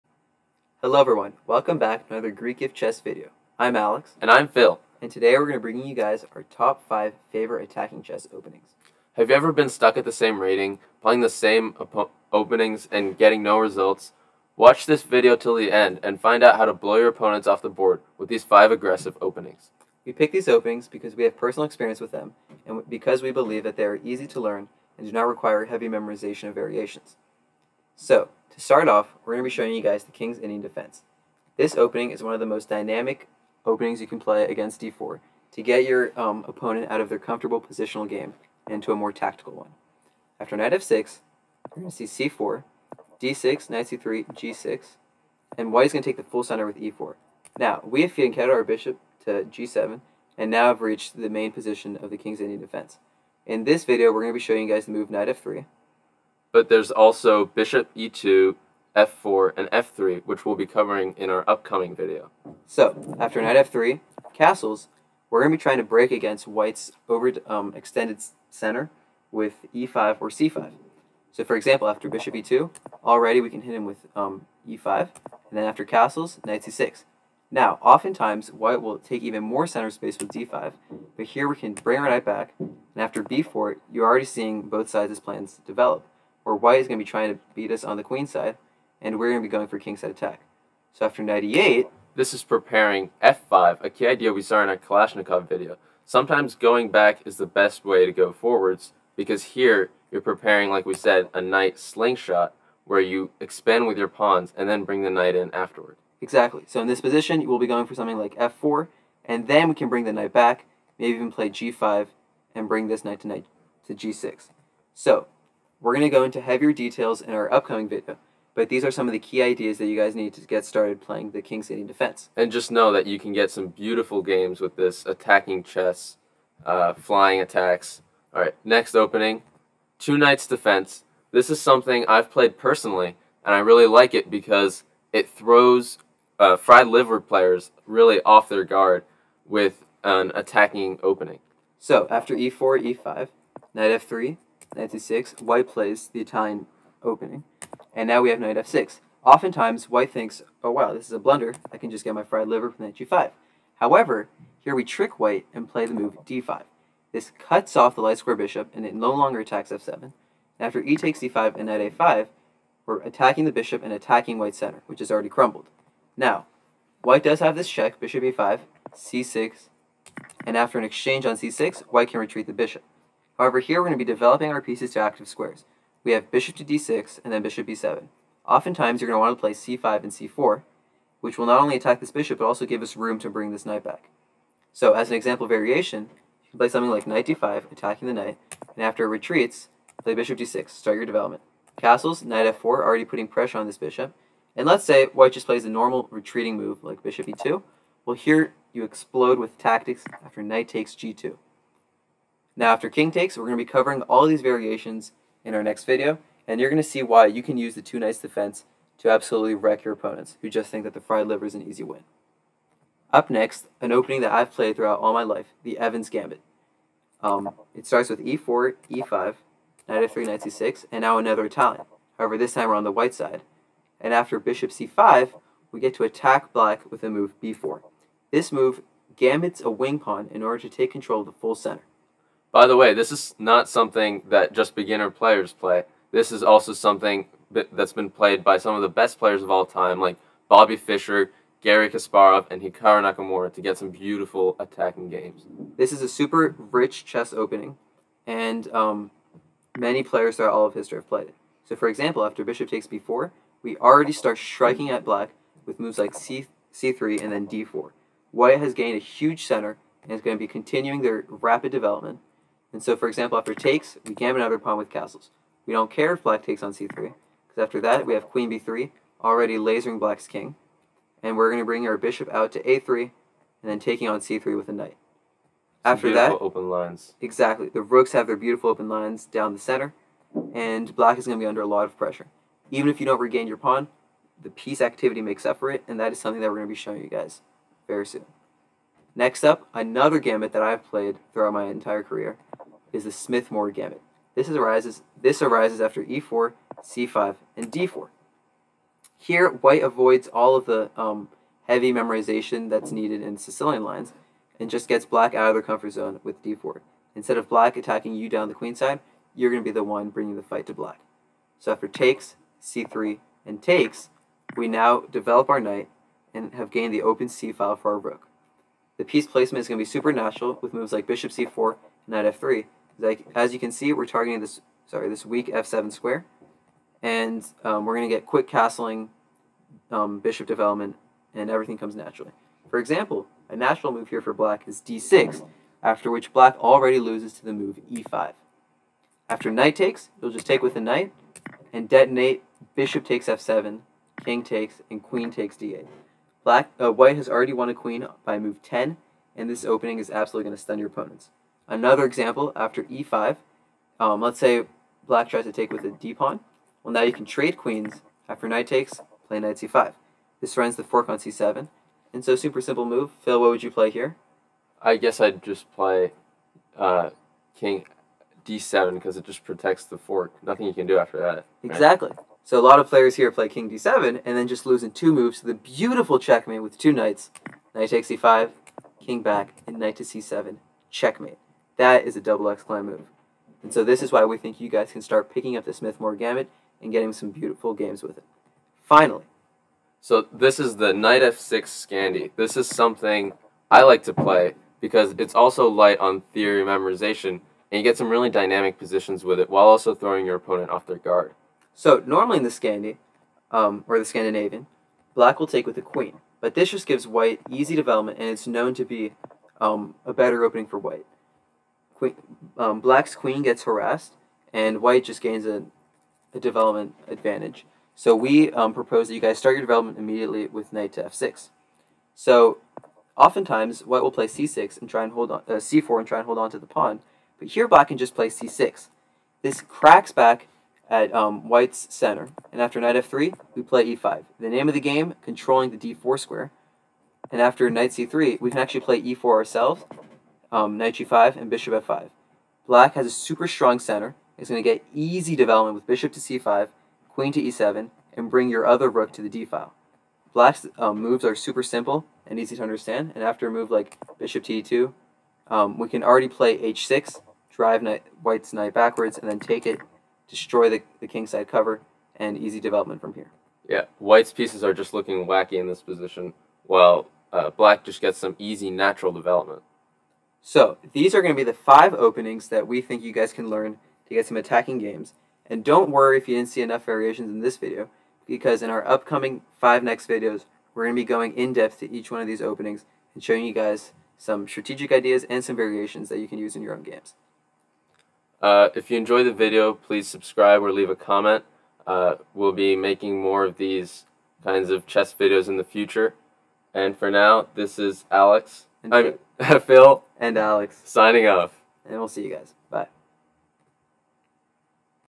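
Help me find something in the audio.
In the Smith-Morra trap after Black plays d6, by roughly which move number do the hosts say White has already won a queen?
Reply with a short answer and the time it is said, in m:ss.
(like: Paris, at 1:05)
10, at 5:48.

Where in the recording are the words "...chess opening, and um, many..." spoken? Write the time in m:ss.
4:07.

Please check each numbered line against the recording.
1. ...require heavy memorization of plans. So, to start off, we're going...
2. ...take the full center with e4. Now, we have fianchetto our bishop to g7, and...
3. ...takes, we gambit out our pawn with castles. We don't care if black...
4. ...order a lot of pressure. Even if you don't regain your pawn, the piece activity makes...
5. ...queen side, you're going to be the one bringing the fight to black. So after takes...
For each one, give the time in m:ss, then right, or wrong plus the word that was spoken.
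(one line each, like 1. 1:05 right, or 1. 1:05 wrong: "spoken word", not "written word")
1. 0:25 wrong: "variations", not "plans"
2. 0:46 right
3. 4:23 right
4. 4:41 wrong: "under", not "order"
5. 5:08 right.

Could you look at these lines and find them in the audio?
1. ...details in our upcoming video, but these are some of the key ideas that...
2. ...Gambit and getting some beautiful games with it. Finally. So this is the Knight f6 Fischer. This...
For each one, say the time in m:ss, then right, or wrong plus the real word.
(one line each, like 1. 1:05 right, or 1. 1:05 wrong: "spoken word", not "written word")
1. 1:56 right
2. 6:26 wrong: "Scandi", not "Fischer".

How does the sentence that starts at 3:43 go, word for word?
And after bishop c5, we get to attack black with the move b4.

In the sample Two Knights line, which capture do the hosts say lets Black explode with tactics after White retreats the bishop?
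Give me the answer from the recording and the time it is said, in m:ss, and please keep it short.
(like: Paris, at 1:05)
Knight takes g2, at 3:20.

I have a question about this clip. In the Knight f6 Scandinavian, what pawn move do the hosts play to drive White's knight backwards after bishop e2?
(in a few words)
h6.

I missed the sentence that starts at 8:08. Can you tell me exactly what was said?
Uh, if you enjoy the video, please subscribe or leave a comment.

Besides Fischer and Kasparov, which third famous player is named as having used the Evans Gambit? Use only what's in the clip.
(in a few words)
Hikaru Nakamura.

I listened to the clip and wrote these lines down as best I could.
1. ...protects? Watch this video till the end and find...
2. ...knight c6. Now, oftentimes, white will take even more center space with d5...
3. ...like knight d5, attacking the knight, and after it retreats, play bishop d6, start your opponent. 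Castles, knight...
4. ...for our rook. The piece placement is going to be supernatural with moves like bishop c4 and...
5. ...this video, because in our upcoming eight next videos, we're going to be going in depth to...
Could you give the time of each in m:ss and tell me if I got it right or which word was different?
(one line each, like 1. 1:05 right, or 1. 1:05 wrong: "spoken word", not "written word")
1. 0:13 wrong: "results", not "protects"
2. 1:16 right
3. 3:06 wrong: "development", not "opponent"
4. 5:17 right
5. 7:57 wrong: "five", not "eight".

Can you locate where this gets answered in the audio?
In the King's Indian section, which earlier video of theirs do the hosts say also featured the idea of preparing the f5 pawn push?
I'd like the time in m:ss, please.
1:34.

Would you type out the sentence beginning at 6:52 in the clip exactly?
Queen, um, black's queen gets harassed, and white just gains a, a development advantage.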